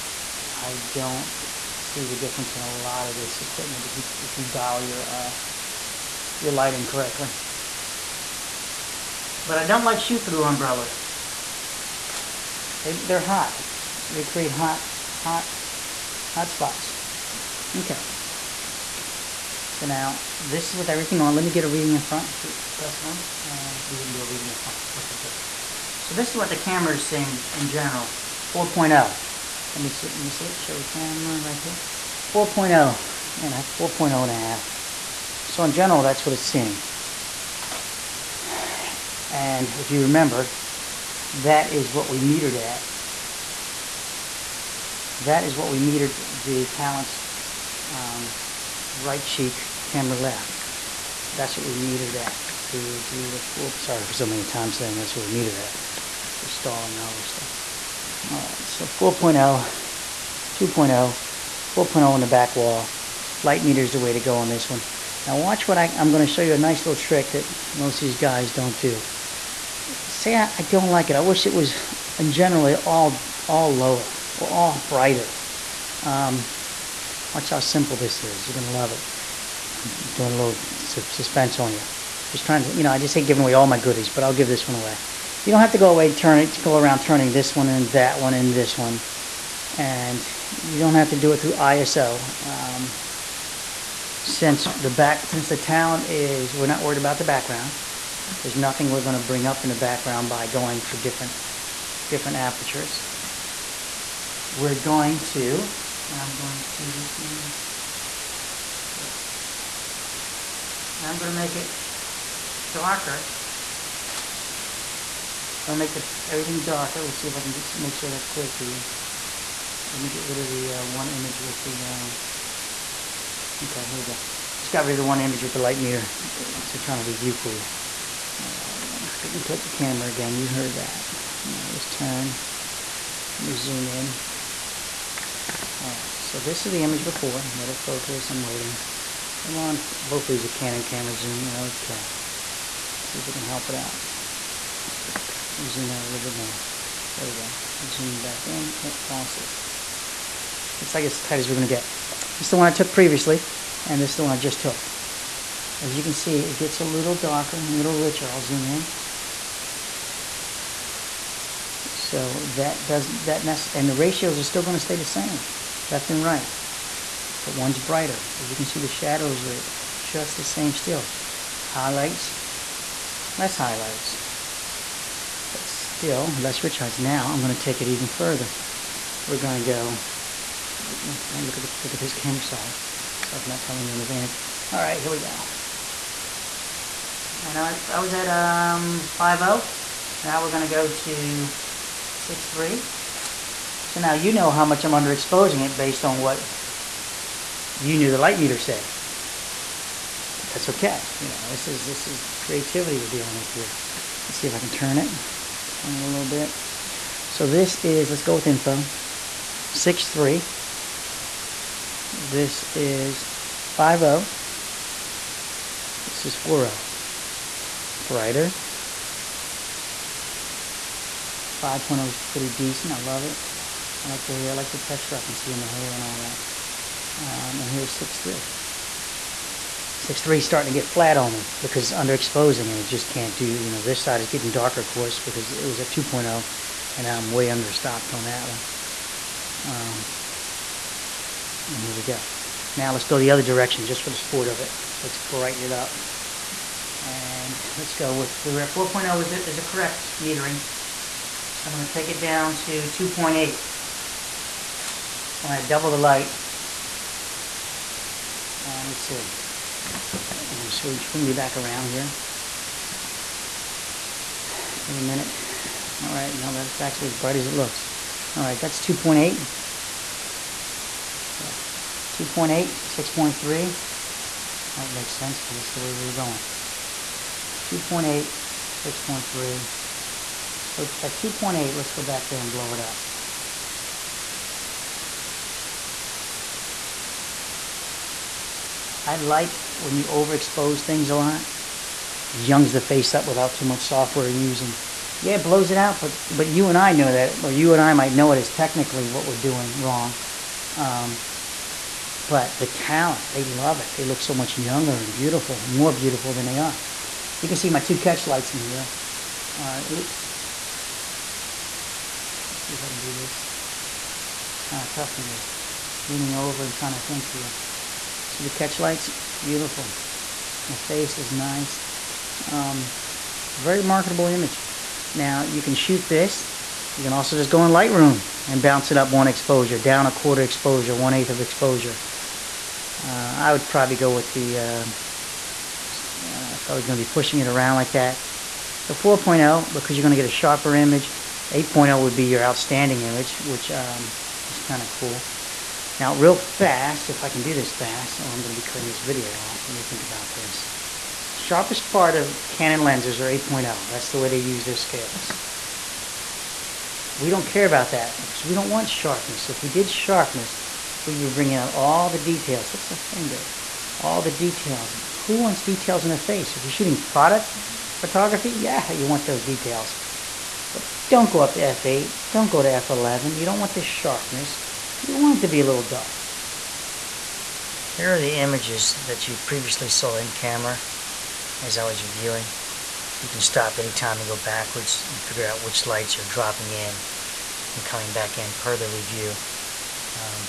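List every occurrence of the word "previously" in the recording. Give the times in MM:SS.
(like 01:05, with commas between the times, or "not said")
02:32, 06:19.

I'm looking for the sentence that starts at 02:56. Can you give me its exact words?
Now I'm going to take it even further.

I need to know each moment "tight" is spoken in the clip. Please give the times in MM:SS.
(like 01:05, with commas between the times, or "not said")
02:31.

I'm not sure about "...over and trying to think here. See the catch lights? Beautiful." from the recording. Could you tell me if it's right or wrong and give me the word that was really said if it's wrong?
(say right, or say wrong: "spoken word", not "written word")
right.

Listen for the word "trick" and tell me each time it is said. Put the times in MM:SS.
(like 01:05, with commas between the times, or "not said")
01:07.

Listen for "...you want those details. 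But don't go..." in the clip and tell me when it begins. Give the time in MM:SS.
06:08.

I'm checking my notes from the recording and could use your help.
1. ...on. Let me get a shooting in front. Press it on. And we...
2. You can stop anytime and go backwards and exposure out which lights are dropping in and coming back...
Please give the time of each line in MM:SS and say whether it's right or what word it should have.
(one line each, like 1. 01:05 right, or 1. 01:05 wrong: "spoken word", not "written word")
1. 00:21 wrong: "reading", not "shooting"
2. 06:23 wrong: "figure", not "exposure".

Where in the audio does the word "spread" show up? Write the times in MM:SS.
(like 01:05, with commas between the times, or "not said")
not said.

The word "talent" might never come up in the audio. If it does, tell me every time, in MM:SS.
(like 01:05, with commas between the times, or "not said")
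00:46, 01:35, 05:02.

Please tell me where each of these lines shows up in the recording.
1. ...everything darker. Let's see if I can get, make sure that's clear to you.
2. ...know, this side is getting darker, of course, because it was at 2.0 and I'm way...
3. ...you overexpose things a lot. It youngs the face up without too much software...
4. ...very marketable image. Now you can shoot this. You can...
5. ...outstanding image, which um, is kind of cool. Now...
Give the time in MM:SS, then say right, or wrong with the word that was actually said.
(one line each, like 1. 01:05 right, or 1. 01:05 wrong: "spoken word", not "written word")
1. 01:56 right
2. 03:53 right
3. 04:49 right
4. 05:23 right
5. 05:42 right.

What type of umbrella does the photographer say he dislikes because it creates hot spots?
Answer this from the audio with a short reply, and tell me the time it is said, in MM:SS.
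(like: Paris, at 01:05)
Shoot-through umbrellas, at 00:09.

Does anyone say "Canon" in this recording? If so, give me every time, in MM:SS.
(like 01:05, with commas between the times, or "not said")
02:20, 05:52.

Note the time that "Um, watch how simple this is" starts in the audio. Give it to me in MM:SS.
01:16.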